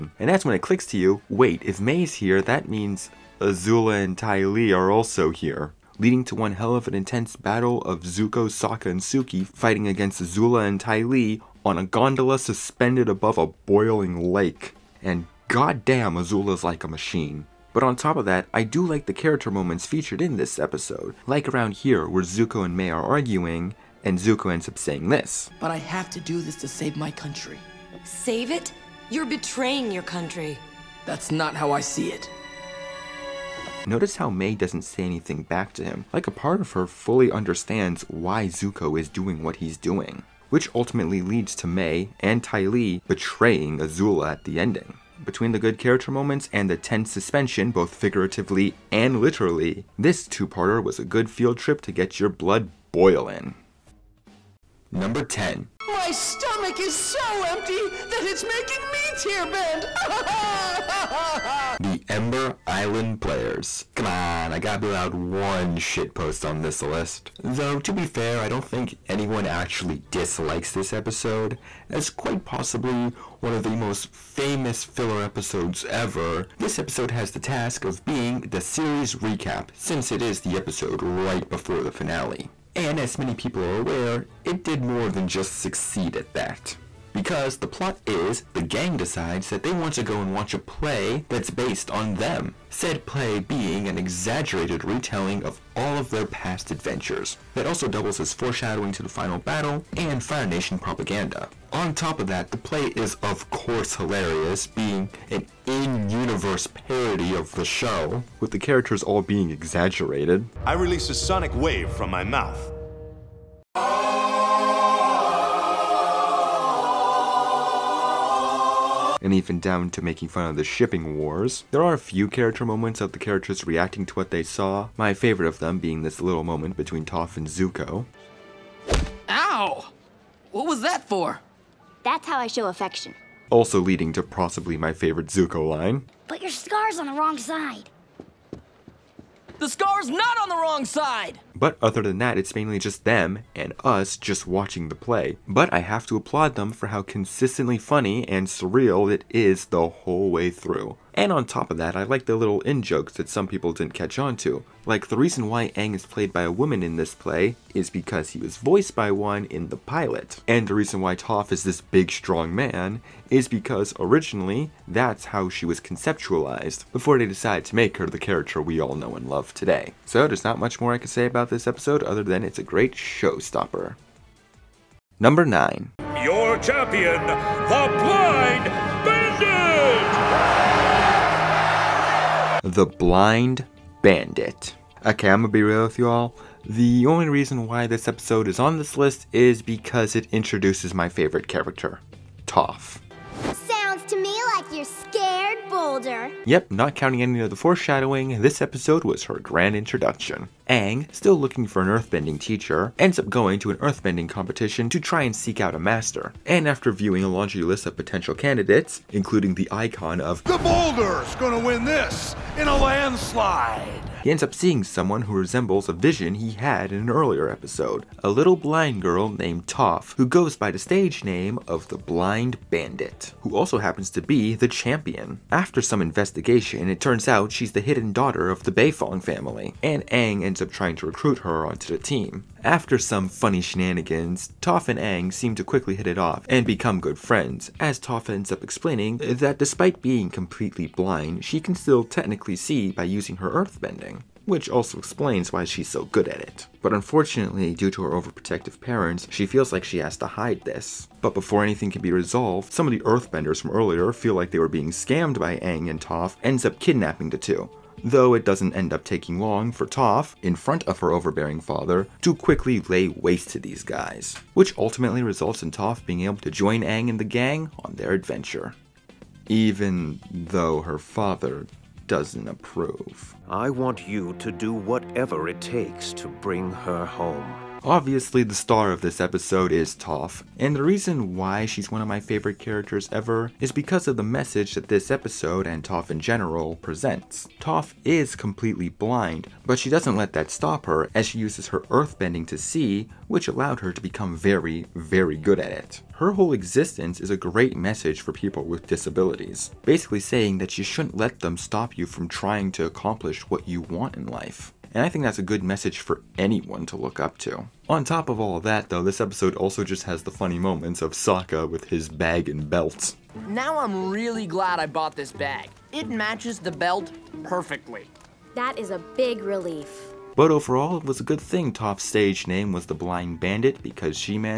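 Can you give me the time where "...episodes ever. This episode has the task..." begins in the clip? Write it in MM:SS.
01:15.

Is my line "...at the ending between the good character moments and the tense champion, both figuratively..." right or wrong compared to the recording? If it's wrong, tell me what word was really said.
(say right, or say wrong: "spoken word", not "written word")
wrong: "suspension", not "champion".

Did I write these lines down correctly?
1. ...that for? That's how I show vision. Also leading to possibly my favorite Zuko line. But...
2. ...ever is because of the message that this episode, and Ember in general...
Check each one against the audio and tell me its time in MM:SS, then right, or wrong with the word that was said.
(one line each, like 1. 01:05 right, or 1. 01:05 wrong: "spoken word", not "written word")
1. 02:10 wrong: "affection", not "vision"
2. 04:43 wrong: "Toph", not "Ember".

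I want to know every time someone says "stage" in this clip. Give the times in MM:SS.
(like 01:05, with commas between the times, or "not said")
03:40, 05:22.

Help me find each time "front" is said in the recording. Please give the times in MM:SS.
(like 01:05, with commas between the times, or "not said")
04:20.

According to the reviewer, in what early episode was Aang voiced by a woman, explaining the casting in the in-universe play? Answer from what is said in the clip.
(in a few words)
The pilot.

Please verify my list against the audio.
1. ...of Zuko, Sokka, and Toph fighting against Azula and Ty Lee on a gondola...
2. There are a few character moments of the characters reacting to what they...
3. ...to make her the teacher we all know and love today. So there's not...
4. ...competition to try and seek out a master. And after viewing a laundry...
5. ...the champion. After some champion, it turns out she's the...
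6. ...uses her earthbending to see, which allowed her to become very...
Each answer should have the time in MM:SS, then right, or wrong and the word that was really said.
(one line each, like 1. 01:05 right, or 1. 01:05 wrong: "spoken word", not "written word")
1. 00:07 wrong: "Suki", not "Toph"
2. 02:01 right
3. 02:47 wrong: "character", not "teacher"
4. 03:24 right
5. 03:44 wrong: "investigation", not "champion"
6. 04:51 right.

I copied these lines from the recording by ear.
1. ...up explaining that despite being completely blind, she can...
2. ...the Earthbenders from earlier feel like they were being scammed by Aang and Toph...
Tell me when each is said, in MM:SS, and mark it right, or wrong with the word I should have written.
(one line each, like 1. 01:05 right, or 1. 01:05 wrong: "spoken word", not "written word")
1. 03:58 right
2. 04:12 right.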